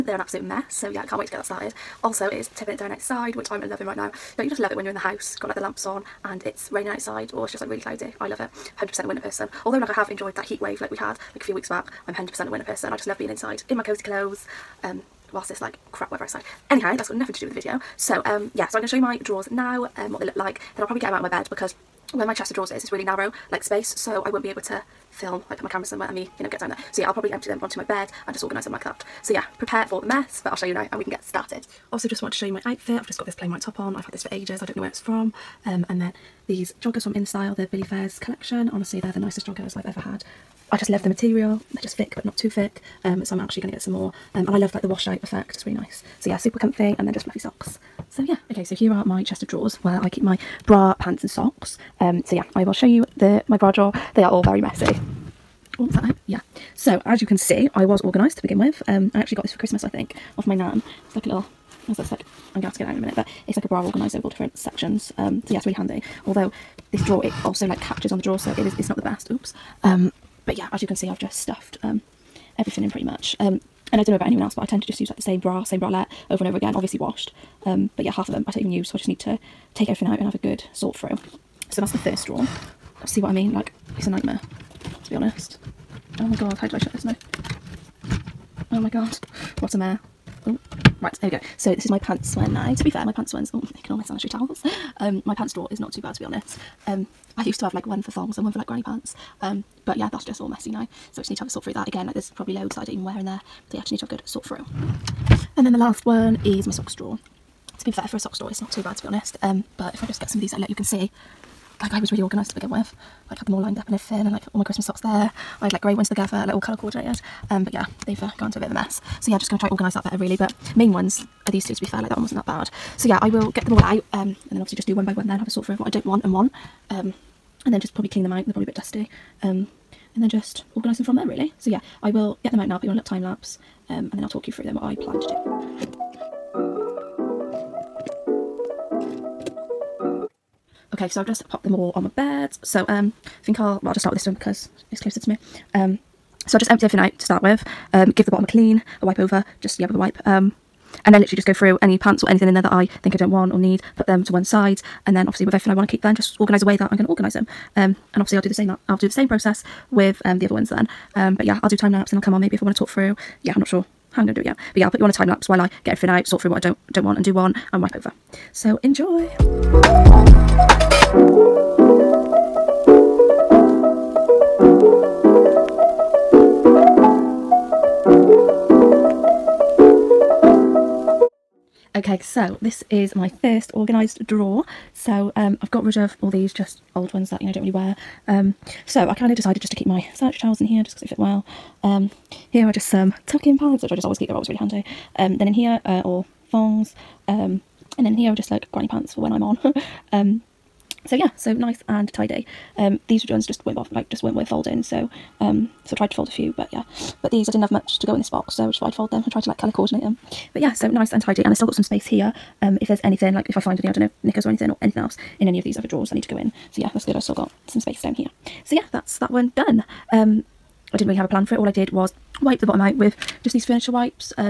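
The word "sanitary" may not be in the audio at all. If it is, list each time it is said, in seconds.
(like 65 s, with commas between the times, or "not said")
94 s, 190 s.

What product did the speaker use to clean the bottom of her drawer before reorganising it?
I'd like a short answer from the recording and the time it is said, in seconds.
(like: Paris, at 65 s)
furniture wipes, at 223 s.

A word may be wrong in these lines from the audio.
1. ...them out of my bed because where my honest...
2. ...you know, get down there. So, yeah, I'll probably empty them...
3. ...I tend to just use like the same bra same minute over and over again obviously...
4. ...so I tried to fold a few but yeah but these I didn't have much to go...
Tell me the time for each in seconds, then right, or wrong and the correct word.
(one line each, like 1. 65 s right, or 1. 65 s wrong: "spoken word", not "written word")
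1. 21 s wrong: "chest", not "honest"
2. 26 s right
3. 74 s wrong: "bralette", not "minute"
4. 205 s right.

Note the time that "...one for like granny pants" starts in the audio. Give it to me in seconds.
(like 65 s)
98 s.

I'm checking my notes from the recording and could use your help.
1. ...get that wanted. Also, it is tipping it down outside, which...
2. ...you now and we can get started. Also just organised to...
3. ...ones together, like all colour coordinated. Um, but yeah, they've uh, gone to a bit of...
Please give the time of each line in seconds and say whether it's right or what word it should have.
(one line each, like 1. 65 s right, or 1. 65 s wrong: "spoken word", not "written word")
1. 1 s wrong: "started", not "wanted"
2. 30 s wrong: "wanted", not "organised"
3. 115 s right.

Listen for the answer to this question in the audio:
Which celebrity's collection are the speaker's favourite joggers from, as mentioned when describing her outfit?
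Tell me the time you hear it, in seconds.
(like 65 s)
37 s.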